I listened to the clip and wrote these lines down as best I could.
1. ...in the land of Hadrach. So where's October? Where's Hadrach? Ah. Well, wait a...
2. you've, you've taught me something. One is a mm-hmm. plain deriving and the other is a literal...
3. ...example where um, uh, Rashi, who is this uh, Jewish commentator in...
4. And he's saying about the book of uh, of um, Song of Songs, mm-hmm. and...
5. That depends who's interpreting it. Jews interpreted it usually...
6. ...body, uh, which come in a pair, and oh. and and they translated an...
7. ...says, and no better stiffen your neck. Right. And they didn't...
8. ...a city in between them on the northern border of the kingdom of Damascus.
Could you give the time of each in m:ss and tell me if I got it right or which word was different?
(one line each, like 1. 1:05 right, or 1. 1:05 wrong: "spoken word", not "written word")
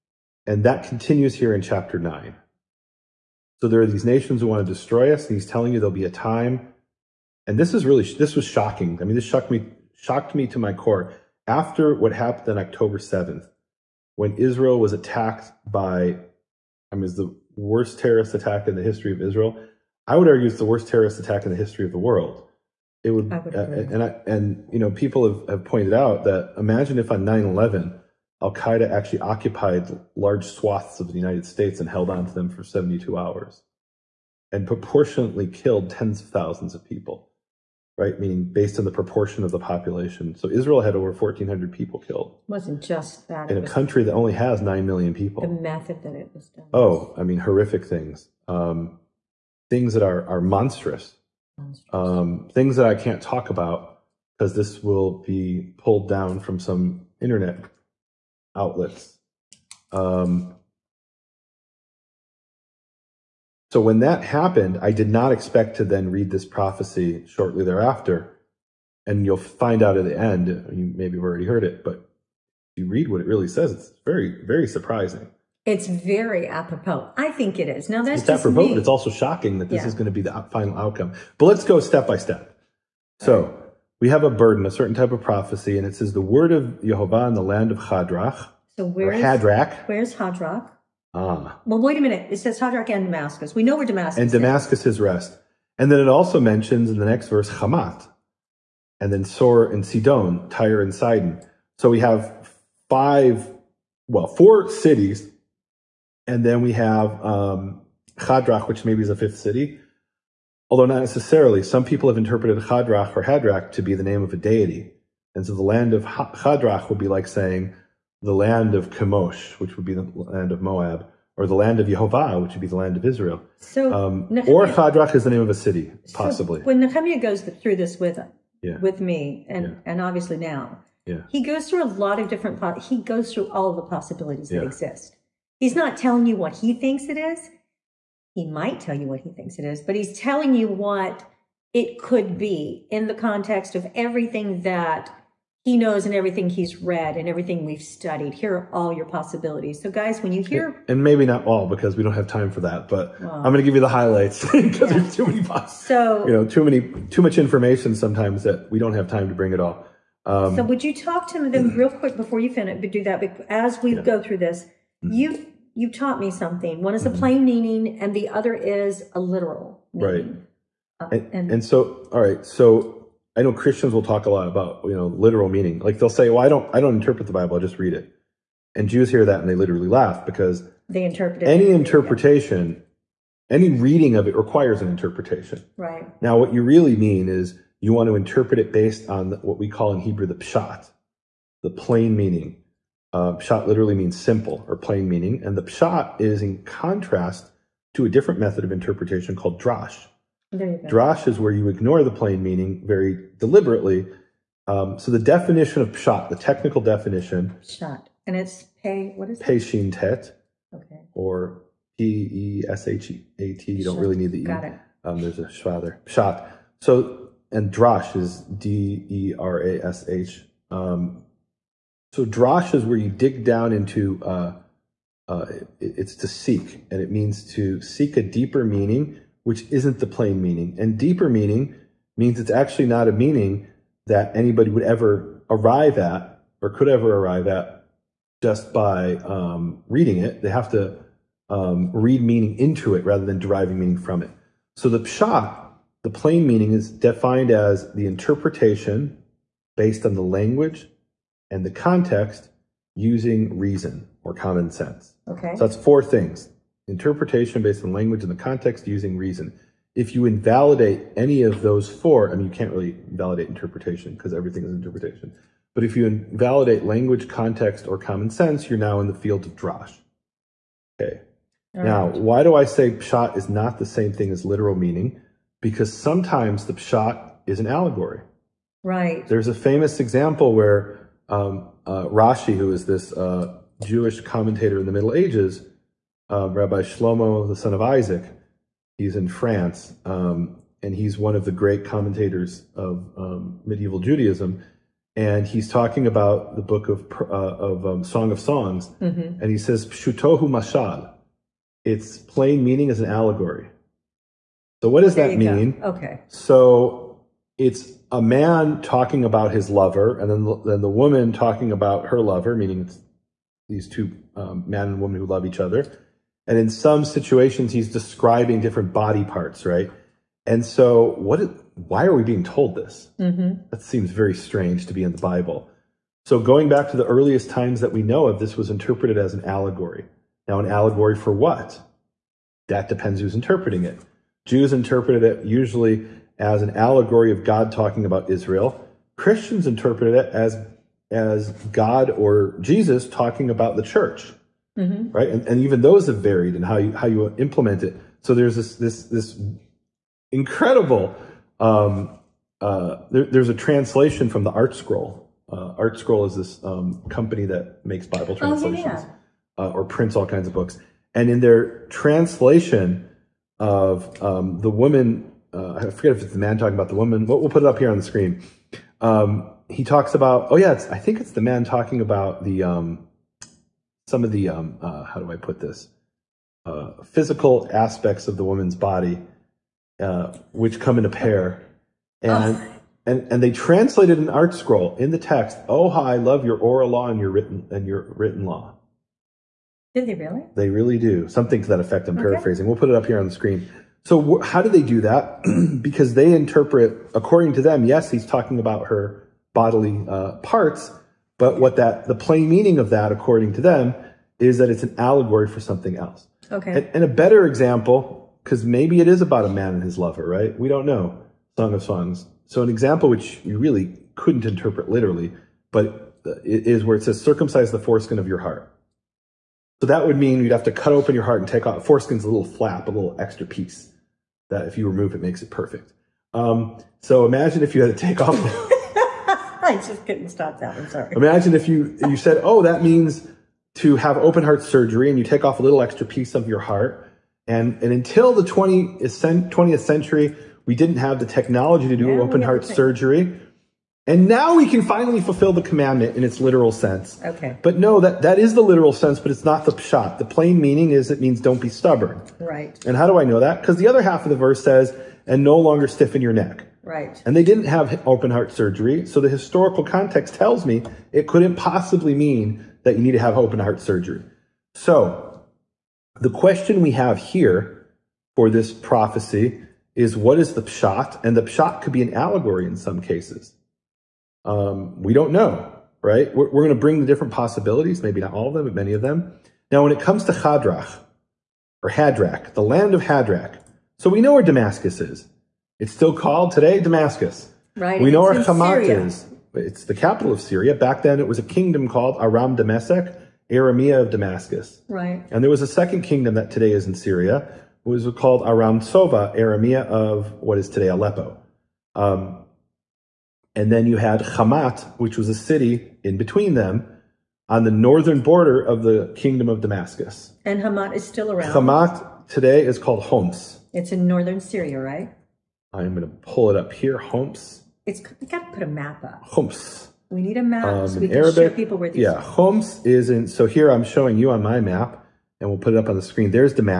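1. 1:27 wrong: "Hadrach", not "October"
2. 2:45 wrong: "meaning", not "deriving"
3. 4:39 right
4. 4:55 wrong: "talking", not "saying"
5. 5:32 right
6. 6:18 right
7. 7:34 wrong: "longer", not "better"
8. 8:25 right.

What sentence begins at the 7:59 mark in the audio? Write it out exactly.
Now, when it comes to Hadrach or Hadrach, the land of Hadrach, so we know where Damascus is.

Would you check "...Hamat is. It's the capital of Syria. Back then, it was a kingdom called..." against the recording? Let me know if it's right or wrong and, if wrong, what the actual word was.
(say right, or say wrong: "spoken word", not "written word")
right.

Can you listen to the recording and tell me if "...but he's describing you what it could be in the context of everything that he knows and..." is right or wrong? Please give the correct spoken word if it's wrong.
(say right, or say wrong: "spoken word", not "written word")
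wrong: "telling", not "describing".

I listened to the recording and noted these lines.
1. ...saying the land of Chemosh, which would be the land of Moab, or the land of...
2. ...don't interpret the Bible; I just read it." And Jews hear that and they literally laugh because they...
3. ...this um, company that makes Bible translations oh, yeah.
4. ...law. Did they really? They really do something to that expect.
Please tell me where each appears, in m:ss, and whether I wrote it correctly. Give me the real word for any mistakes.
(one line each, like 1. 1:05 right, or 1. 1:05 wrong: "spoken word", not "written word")
1. 1:57 right
2. 2:56 right
3. 5:56 right
4. 6:28 wrong: "effect", not "expect".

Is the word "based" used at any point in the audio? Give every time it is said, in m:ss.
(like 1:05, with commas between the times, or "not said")
0:38, 3:08, 4:09, 4:17.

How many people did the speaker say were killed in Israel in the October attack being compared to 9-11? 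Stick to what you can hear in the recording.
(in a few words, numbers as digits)
over 1,400.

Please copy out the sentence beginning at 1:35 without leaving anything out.
And then it also mentions in the next verse Hamat, and then Sor and Sidon, Tyre and Sidon.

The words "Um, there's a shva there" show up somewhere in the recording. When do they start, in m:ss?
3:35.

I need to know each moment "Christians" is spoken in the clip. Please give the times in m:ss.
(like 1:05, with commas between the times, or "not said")
2:53, 5:39.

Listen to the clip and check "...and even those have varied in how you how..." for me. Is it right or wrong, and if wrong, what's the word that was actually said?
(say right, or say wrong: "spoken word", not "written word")
right.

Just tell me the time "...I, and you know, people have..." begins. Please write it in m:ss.
0:24.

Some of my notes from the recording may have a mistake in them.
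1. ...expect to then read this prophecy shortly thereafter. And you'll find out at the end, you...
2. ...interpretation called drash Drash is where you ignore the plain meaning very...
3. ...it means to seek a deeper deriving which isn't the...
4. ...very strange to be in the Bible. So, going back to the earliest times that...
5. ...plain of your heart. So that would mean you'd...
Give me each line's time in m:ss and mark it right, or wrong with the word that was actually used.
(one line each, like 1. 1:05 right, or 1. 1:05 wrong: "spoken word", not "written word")
1. 1:05 right
2. 3:18 right
3. 3:46 wrong: "meaning", not "deriving"
4. 5:24 right
5. 6:57 wrong: "foreskin", not "plain".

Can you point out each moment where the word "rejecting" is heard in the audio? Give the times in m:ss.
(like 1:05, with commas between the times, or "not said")
not said.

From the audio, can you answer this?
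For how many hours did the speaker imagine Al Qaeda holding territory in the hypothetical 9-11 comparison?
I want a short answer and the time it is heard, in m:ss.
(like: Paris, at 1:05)
72, at 0:32.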